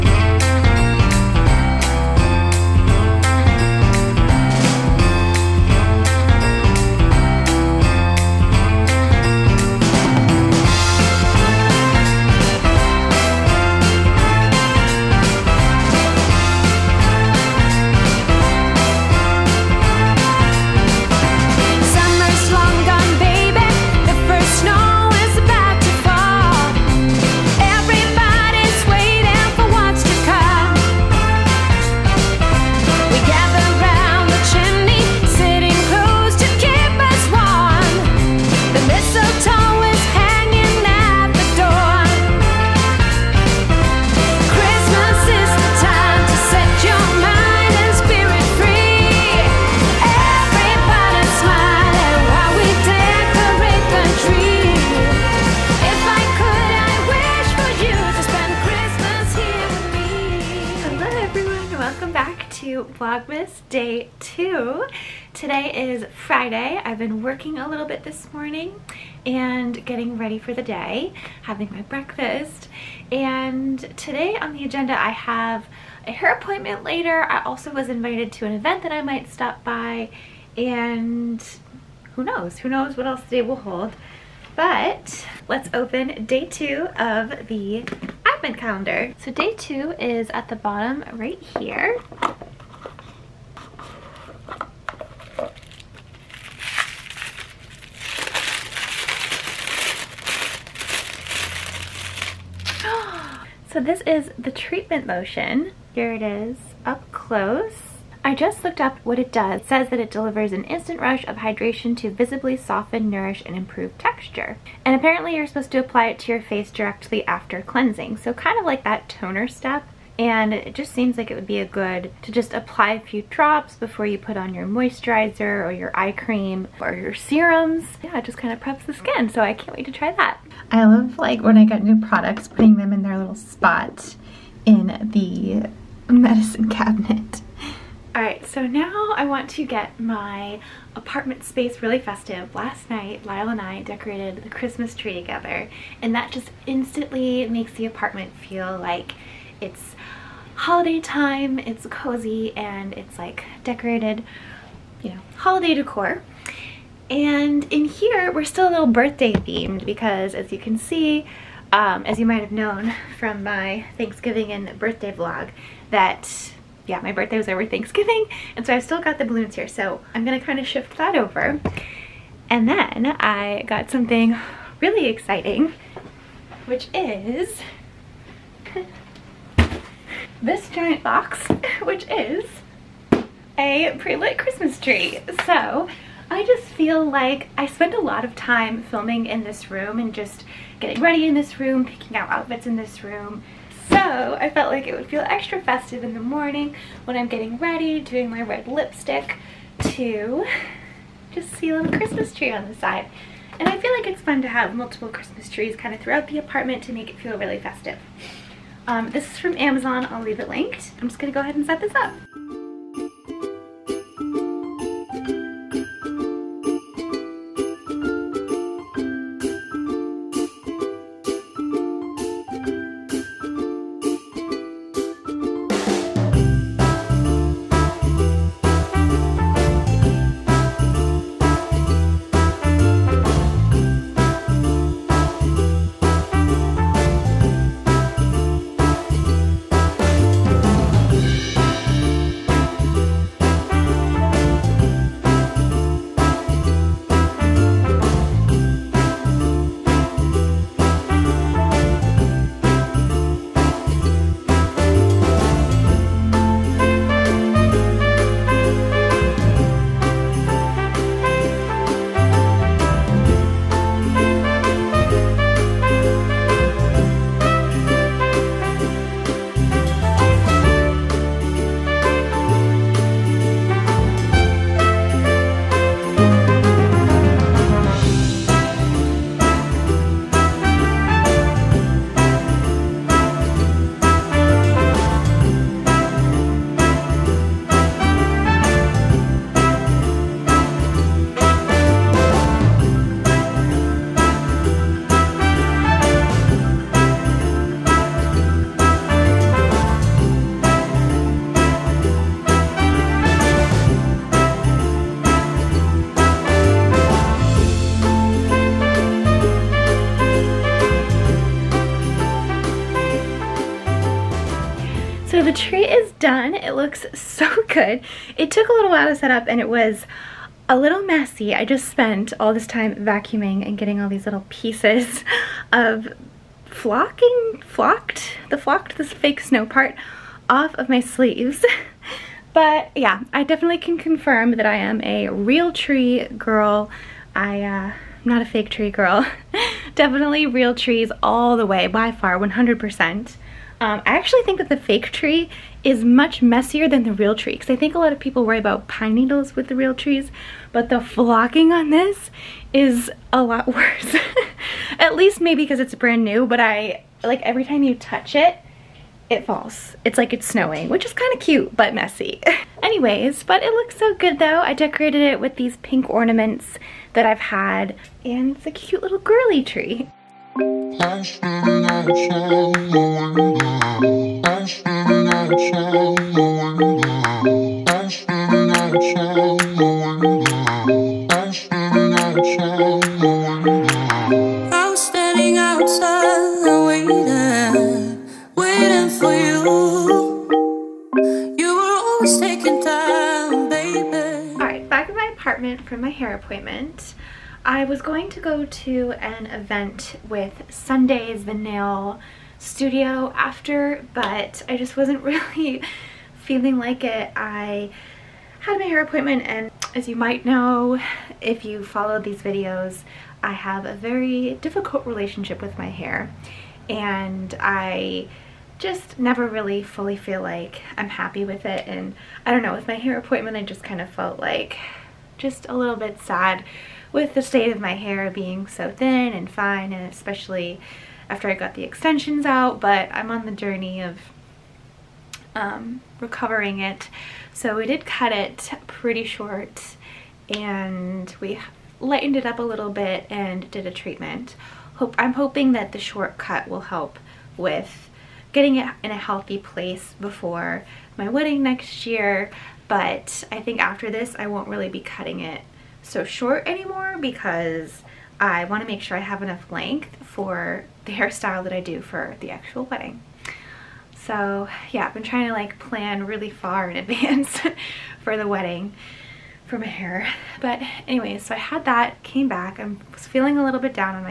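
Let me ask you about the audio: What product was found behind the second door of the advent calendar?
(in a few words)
treatment lotion.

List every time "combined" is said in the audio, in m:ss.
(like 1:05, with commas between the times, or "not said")
not said.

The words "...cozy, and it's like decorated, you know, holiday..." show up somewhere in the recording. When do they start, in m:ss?
2:31.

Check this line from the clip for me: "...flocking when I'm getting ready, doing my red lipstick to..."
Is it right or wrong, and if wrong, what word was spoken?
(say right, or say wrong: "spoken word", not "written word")
wrong: "morning", not "flocking".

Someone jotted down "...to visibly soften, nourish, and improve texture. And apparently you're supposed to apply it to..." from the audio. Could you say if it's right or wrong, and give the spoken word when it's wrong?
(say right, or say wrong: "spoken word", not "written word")
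right.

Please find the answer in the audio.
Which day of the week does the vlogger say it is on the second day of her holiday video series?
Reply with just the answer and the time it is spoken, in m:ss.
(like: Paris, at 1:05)
Friday, at 1:06.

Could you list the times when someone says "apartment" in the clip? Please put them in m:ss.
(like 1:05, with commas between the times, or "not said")
2:20, 2:27, 3:26, 6:35.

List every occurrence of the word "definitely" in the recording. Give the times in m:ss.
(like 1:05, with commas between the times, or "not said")
5:33, 5:39.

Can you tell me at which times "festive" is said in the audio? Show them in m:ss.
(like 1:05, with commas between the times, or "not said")
2:21, 3:15, 3:27.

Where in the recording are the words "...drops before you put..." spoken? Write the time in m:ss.
2:03.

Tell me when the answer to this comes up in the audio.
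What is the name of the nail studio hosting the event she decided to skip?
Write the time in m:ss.
6:40.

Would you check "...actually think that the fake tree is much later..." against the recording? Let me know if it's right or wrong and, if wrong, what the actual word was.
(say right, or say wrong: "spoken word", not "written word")
wrong: "messier", not "later".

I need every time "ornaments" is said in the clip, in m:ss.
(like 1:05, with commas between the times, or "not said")
6:06.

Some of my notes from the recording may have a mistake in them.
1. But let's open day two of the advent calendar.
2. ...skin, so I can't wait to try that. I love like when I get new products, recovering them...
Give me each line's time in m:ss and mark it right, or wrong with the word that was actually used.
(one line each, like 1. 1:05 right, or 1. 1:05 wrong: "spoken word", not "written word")
1. 1:24 right
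2. 2:08 wrong: "putting", not "recovering".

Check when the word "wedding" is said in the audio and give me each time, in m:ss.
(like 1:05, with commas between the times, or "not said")
7:31, 7:42, 7:48.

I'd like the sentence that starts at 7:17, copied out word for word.
So we did cut it pretty short and we lightened it up a little bit and did a treatment.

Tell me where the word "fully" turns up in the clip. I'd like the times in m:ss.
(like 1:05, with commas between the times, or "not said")
6:59.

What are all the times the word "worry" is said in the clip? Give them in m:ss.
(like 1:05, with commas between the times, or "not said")
5:48.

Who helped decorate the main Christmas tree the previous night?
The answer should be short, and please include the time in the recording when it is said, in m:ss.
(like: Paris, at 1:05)
Lyle, at 2:23.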